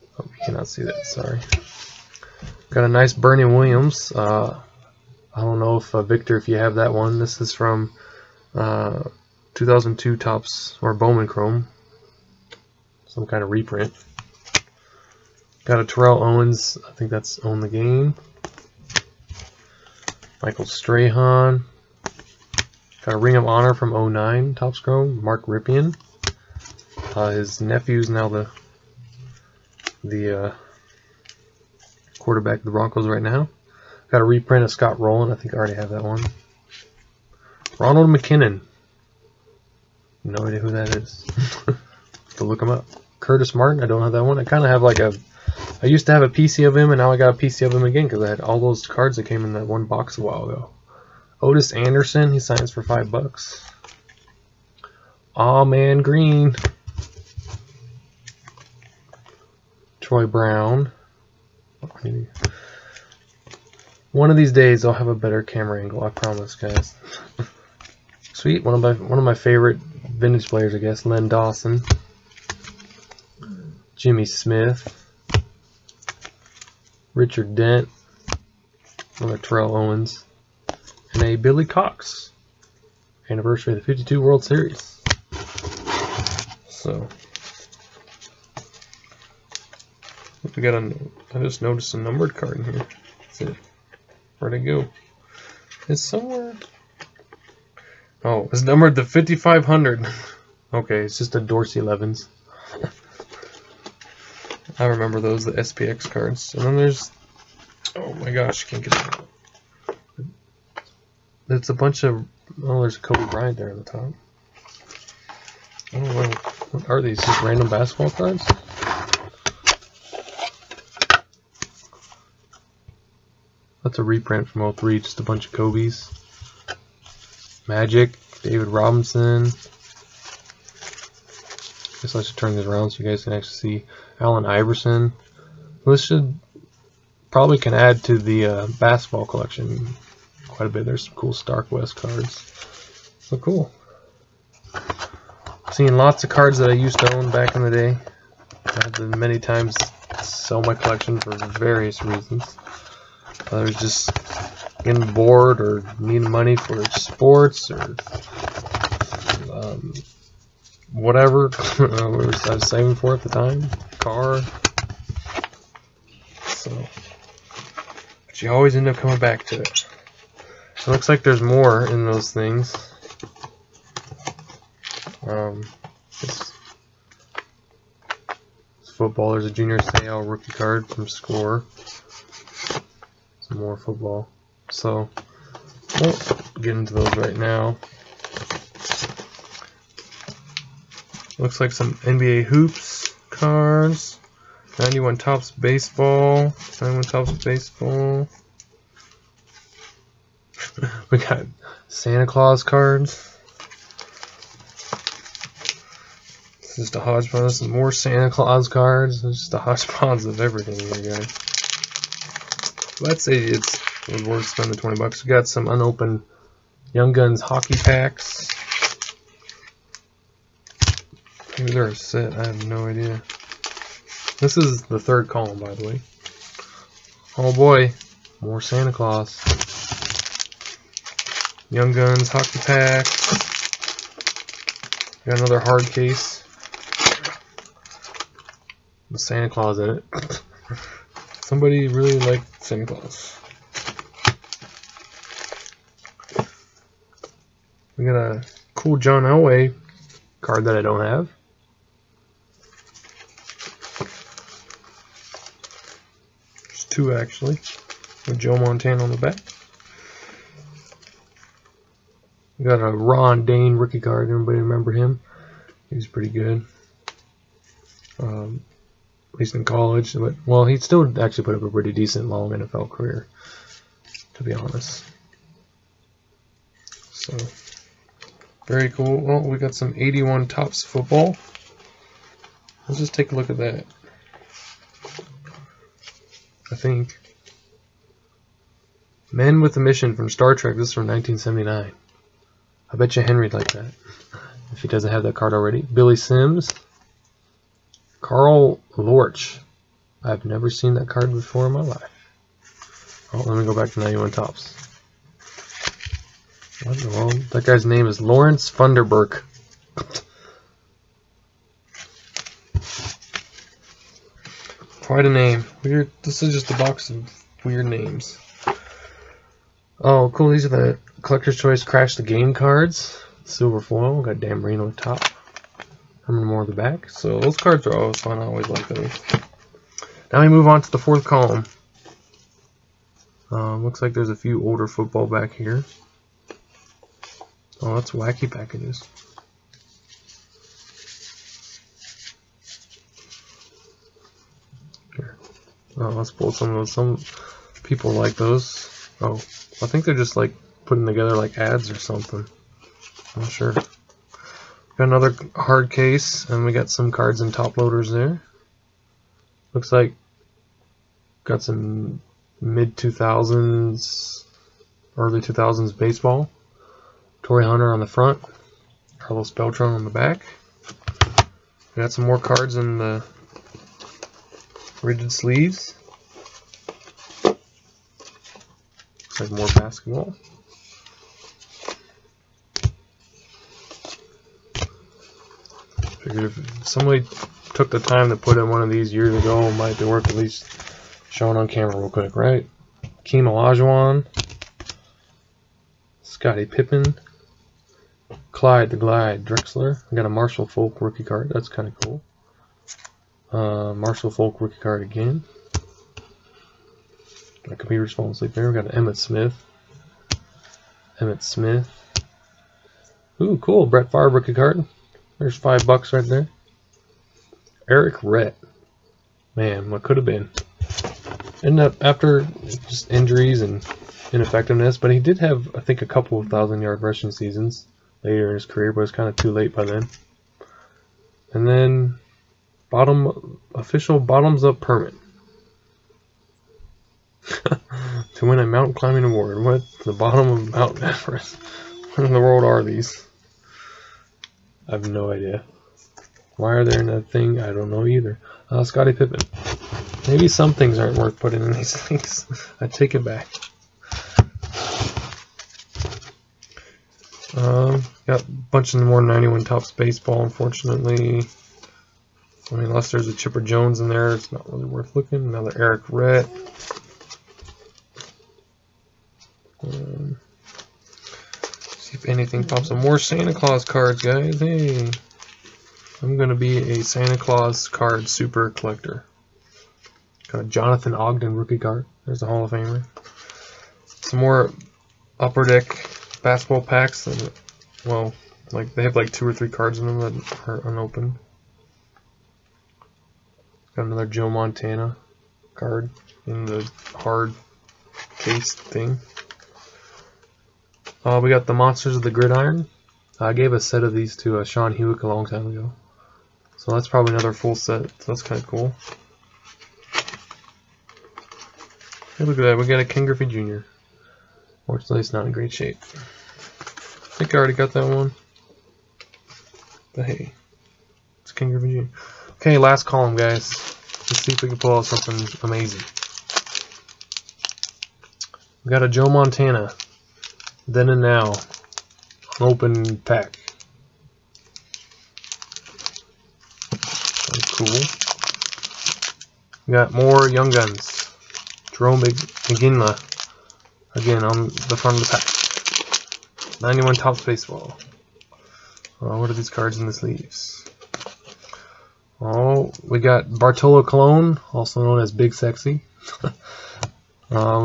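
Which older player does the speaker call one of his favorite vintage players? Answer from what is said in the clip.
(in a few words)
Len Dawson.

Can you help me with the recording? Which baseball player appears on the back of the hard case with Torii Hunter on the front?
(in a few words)
Carlos Beltran.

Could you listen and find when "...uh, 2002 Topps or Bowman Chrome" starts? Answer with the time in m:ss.
0:08.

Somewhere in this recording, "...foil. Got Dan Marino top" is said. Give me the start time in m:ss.
5:23.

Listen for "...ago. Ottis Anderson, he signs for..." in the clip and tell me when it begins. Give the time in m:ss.
0:50.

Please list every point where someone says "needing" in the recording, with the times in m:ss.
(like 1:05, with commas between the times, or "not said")
2:35.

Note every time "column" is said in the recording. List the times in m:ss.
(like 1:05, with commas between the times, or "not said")
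3:45, 5:31, 8:43.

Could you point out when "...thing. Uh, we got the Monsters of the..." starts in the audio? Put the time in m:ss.
8:18.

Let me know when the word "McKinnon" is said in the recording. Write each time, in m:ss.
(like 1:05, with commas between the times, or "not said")
0:38.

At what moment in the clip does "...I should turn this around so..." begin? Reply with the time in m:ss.
2:12.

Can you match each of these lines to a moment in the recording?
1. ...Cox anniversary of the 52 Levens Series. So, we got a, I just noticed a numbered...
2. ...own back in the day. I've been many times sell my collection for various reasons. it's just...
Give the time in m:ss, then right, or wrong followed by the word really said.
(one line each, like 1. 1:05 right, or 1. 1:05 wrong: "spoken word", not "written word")
1. 1:21 wrong: "World", not "Levens"
2. 2:27 right.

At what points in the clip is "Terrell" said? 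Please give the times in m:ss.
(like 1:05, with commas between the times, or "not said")
0:15, 1:19.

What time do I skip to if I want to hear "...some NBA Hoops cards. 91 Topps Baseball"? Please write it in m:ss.
3:11.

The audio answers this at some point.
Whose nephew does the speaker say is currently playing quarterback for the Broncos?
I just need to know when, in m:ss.
0:25.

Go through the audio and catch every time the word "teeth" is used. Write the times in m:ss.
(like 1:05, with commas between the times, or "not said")
not said.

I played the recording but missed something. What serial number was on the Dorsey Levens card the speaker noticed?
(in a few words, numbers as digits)
5500.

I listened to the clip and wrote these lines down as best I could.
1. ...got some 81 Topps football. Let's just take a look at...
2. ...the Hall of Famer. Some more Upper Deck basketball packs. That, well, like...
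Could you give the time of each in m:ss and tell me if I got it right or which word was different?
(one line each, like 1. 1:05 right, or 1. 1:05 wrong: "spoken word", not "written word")
1. 4:39 right
2. 8:02 right.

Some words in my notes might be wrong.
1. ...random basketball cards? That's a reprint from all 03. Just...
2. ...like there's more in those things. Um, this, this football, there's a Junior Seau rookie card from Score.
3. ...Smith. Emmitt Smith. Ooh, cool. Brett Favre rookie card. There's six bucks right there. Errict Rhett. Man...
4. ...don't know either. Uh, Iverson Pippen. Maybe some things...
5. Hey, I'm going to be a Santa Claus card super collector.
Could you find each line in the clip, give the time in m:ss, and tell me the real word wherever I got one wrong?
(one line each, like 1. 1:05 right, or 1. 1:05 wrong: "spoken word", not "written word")
1. 1:57 right
2. 2:51 right
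3. 6:49 wrong: "five", not "six"
4. 7:27 wrong: "Scottie", not "Iverson"
5. 7:54 right.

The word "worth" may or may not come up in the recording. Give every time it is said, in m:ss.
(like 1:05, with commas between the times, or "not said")
3:34, 6:30, 7:31, 7:44.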